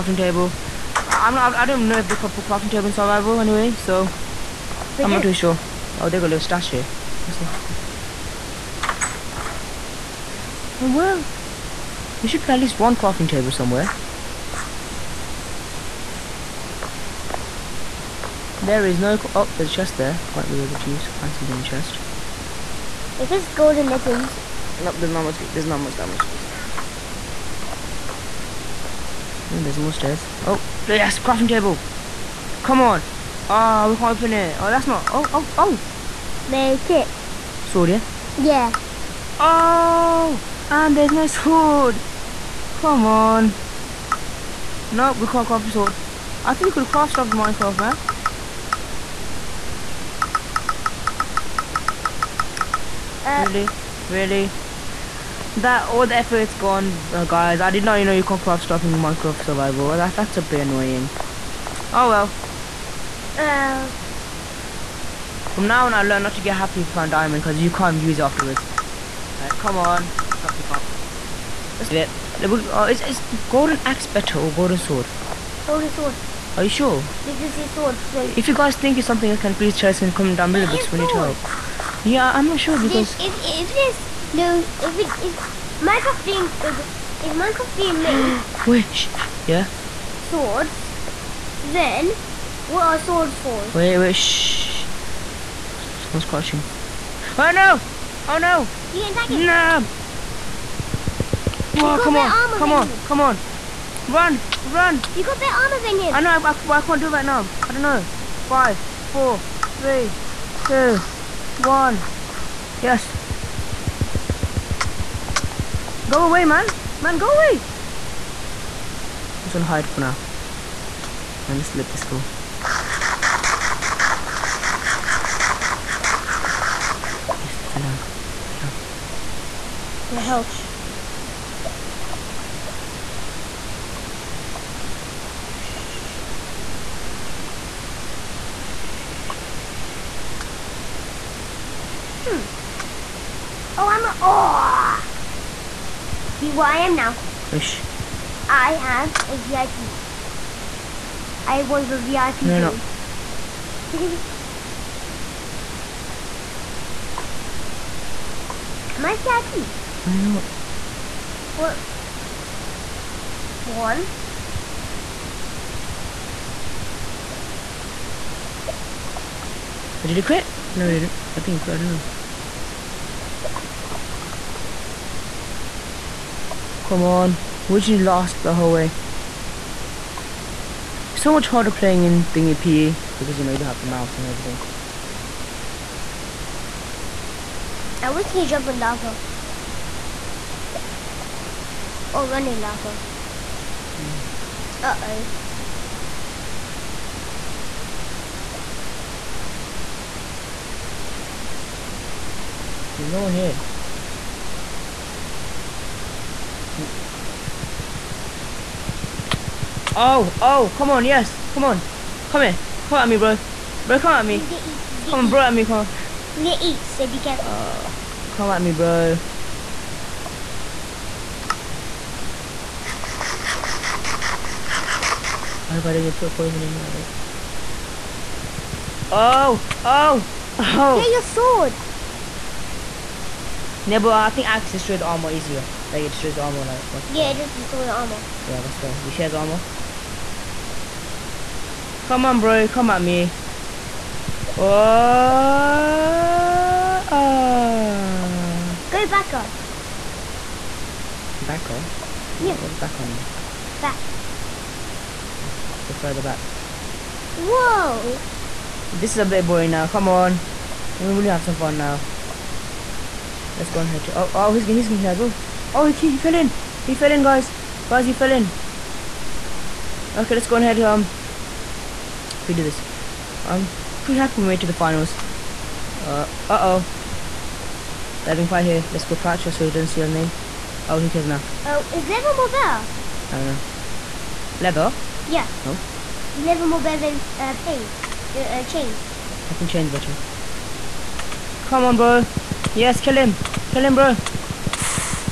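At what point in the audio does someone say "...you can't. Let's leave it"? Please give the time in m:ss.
1:10.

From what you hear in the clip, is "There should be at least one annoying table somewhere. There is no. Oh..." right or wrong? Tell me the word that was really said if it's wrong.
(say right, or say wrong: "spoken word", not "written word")
wrong: "crafting", not "annoying".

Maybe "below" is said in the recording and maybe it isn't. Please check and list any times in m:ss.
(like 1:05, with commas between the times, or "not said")
1:20.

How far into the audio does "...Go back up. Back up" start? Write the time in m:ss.
4:08.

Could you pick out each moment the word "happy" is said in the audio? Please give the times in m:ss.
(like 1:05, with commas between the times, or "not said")
1:06, 4:34.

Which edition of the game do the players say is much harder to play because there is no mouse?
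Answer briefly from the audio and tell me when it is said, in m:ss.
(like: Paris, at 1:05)
PE, at 3:02.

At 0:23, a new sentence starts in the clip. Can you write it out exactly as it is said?
If it's golden legends, Nope, there's not much.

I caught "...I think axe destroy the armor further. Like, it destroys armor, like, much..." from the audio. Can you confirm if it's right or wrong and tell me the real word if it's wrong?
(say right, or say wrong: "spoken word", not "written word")
wrong: "easier", not "further".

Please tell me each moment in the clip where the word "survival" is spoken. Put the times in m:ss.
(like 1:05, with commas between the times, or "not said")
0:02, 0:59.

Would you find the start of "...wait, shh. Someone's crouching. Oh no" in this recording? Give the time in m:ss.
1:33.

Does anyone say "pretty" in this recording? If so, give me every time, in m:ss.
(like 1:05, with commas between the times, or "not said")
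4:34.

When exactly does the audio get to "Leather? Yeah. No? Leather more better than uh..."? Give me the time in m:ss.
4:44.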